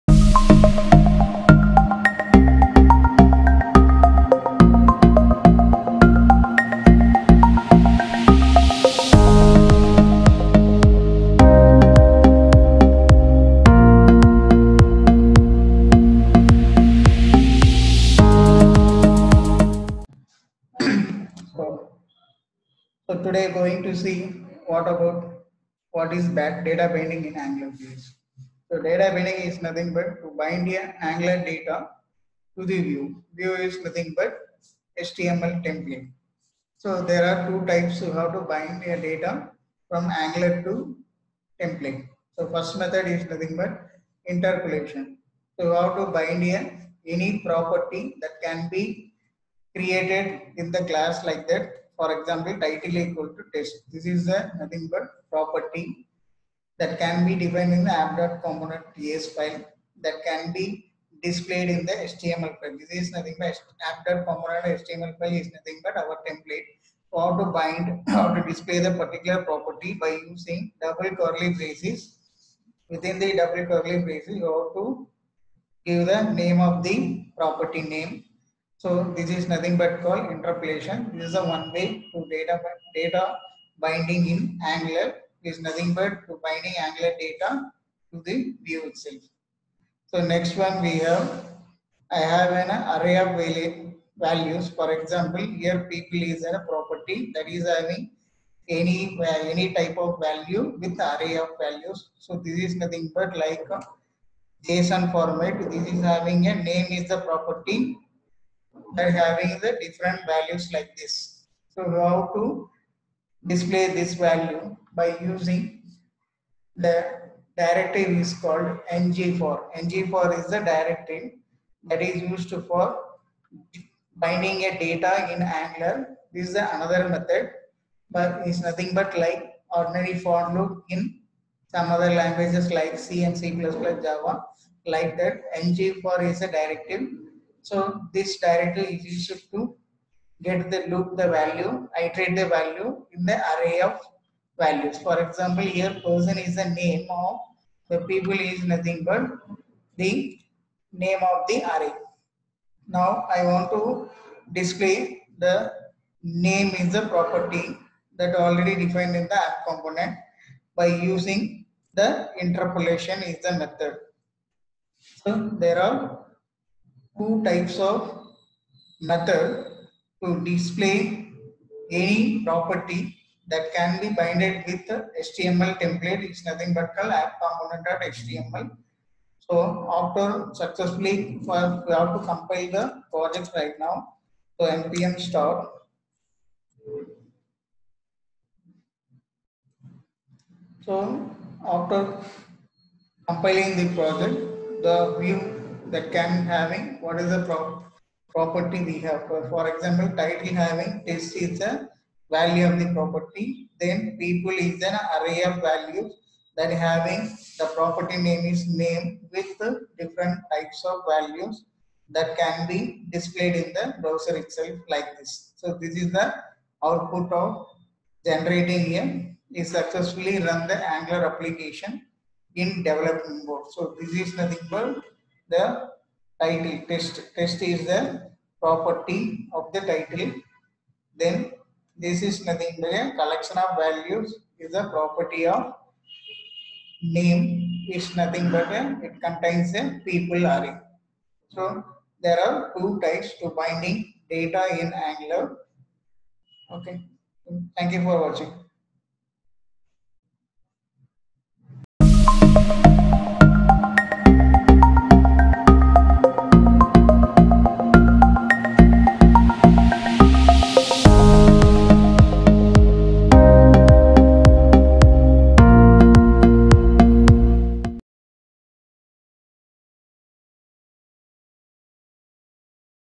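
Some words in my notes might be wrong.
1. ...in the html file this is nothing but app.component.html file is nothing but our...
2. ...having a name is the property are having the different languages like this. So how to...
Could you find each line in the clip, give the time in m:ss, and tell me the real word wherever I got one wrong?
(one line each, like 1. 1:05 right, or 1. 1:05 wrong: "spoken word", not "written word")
1. 1:01 right
2. 1:46 wrong: "values", not "languages".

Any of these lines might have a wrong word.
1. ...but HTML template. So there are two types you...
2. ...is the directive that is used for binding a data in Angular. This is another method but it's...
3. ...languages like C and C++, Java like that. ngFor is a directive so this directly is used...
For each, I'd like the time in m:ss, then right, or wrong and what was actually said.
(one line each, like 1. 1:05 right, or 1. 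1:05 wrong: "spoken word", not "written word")
1. 0:34 right
2. 2:00 right
3. 2:12 right.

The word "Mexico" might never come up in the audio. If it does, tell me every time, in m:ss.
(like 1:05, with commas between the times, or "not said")
not said.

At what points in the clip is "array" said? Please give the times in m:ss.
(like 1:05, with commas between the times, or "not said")
1:32, 1:41, 2:23, 2:31, 3:25, 4:00.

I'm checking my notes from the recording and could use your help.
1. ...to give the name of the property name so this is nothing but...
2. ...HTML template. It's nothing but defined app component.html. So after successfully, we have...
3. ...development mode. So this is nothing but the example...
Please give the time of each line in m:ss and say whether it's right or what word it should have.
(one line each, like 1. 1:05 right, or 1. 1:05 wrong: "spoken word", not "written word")
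1. 1:14 right
2. 2:54 wrong: "called", not "defined"
3. 3:42 wrong: "title", not "example".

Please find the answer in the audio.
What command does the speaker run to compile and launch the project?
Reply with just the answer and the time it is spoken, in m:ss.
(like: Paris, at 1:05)
npm start, at 3:04.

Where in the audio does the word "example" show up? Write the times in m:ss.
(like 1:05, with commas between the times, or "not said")
0:52, 1:34, 2:25, 3:19.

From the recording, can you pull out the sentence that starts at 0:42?
So first method is nothing but interpolation.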